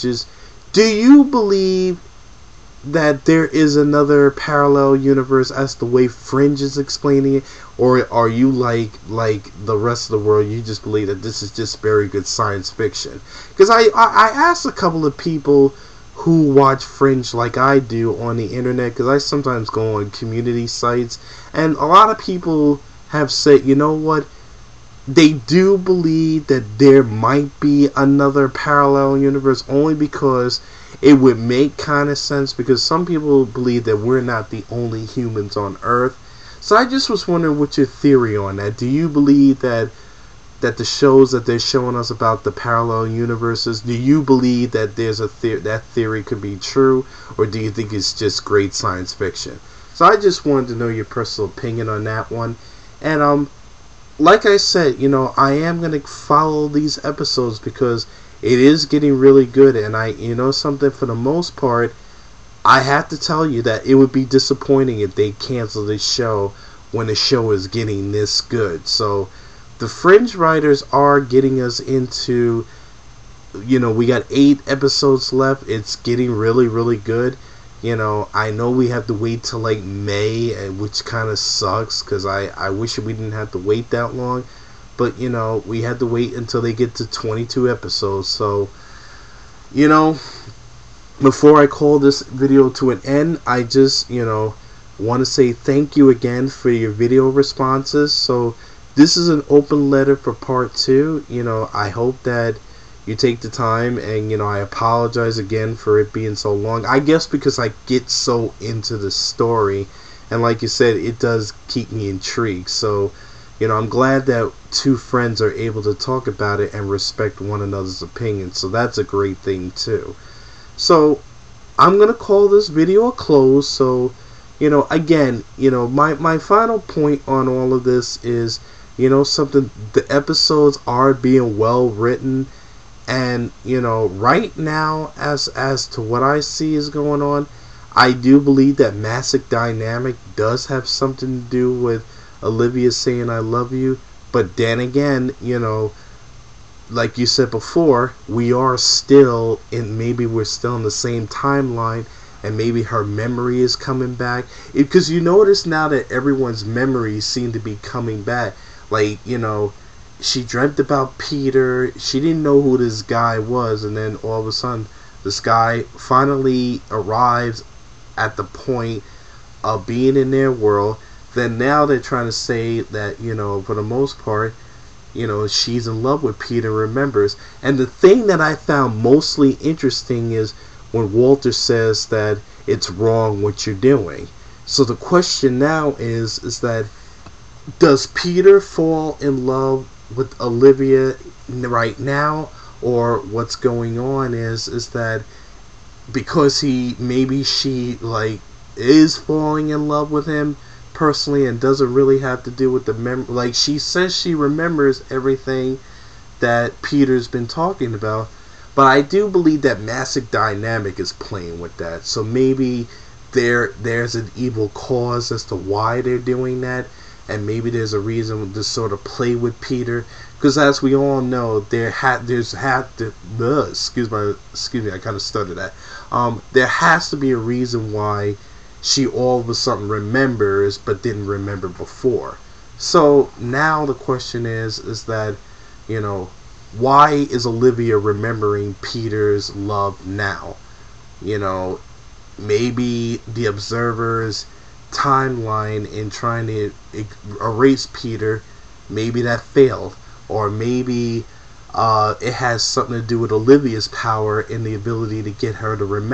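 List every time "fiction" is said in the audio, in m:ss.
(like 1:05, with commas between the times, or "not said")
0:12, 0:49.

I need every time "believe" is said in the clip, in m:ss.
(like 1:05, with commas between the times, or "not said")
0:01, 0:10, 0:25, 0:33, 0:39, 0:44, 2:18, 3:29.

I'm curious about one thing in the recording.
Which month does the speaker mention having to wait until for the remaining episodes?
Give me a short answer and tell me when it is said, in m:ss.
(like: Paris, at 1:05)
May, at 1:19.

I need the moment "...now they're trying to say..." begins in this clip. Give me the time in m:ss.
2:51.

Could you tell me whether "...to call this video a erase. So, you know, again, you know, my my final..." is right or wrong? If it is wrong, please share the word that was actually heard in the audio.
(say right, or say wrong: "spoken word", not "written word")
wrong: "close", not "erase".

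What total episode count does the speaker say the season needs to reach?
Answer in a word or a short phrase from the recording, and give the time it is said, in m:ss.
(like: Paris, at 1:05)
22, at 1:27.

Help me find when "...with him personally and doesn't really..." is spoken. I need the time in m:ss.
3:20.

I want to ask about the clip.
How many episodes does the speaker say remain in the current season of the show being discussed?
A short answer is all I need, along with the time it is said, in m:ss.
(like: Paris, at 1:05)
8, at 1:14.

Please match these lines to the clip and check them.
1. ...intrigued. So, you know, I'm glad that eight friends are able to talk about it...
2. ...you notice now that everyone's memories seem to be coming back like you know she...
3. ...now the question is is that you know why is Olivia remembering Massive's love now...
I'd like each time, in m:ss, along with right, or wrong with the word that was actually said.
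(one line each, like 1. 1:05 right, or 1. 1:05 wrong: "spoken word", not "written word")
1. 1:52 wrong: "two", not "eight"
2. 2:35 right
3. 3:53 wrong: "Peter", not "Massive".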